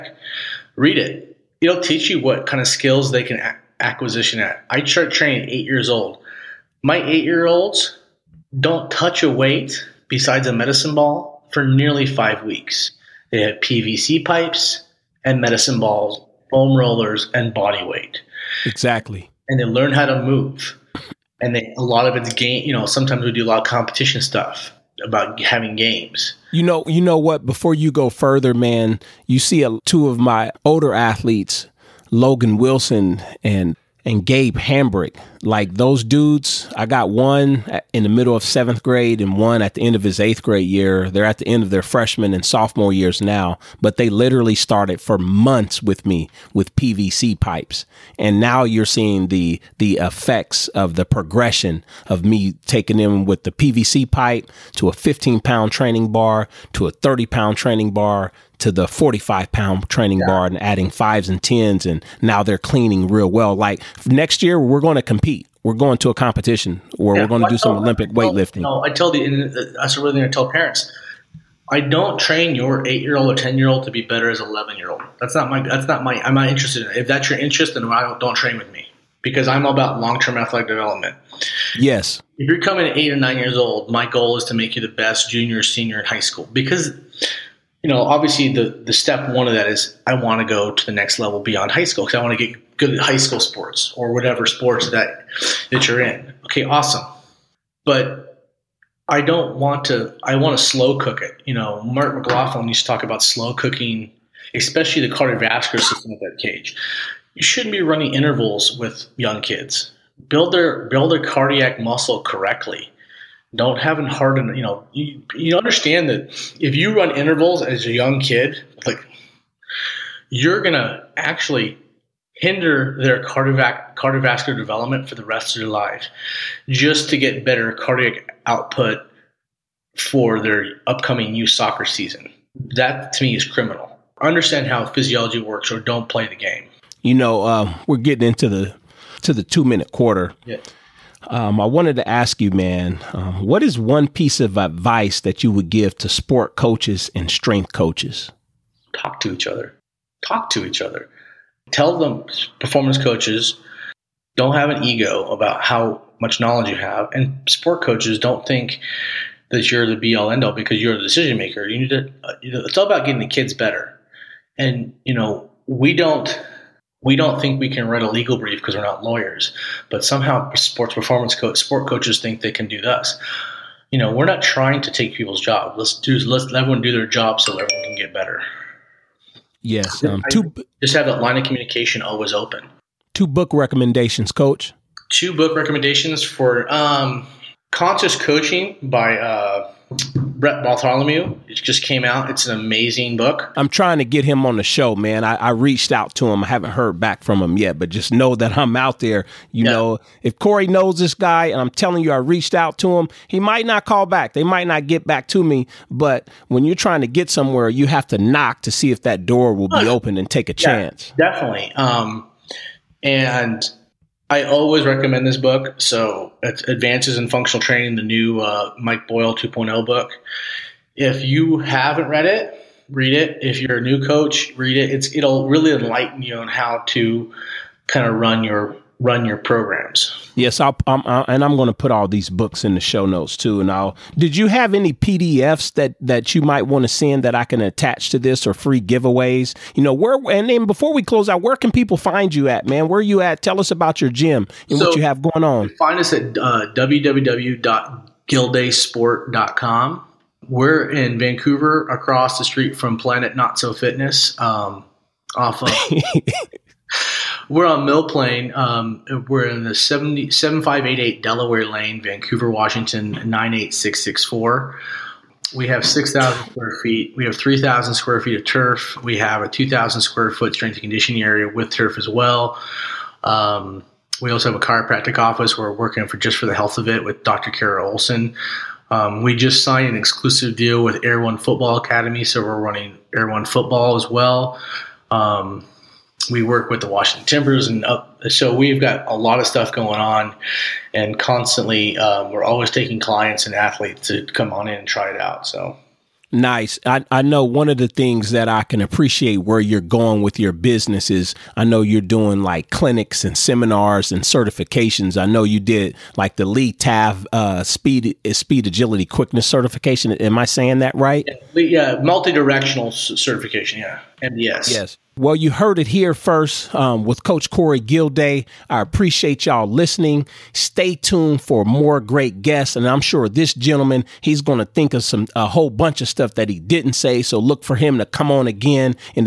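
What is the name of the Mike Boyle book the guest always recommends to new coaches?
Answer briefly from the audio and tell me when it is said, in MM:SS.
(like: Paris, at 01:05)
Advances in Functional Training, at 03:36.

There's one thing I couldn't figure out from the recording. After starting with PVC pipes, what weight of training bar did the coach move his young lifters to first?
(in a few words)
15 pound.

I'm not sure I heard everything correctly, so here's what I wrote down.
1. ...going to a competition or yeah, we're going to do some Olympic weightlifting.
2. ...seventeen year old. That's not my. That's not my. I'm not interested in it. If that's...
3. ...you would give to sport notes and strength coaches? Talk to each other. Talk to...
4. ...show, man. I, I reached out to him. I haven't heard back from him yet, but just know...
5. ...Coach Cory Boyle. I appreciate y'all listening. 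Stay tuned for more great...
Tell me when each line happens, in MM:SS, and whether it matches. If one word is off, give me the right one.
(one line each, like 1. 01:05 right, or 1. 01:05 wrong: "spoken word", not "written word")
1. 01:05 right
2. 01:14 wrong: "eleven", not "seventeen"
3. 02:25 wrong: "coaches", not "notes"
4. 03:14 right
5. 05:17 wrong: "Gilday", not "Boyle".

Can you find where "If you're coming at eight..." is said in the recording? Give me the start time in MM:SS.
01:22.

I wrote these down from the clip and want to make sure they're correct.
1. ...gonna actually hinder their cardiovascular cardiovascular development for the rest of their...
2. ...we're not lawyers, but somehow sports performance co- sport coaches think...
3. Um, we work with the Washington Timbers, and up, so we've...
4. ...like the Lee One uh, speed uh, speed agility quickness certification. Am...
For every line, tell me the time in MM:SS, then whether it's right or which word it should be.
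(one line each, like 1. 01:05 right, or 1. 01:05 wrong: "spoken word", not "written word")
1. 02:00 right
2. 02:48 right
3. 04:45 right
4. 05:06 wrong: "Taft", not "One".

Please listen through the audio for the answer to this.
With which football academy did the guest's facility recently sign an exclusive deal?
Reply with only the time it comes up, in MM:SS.
04:41.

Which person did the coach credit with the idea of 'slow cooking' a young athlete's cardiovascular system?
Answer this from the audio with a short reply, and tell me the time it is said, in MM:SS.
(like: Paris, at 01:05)
Mark McLaughlin, at 01:41.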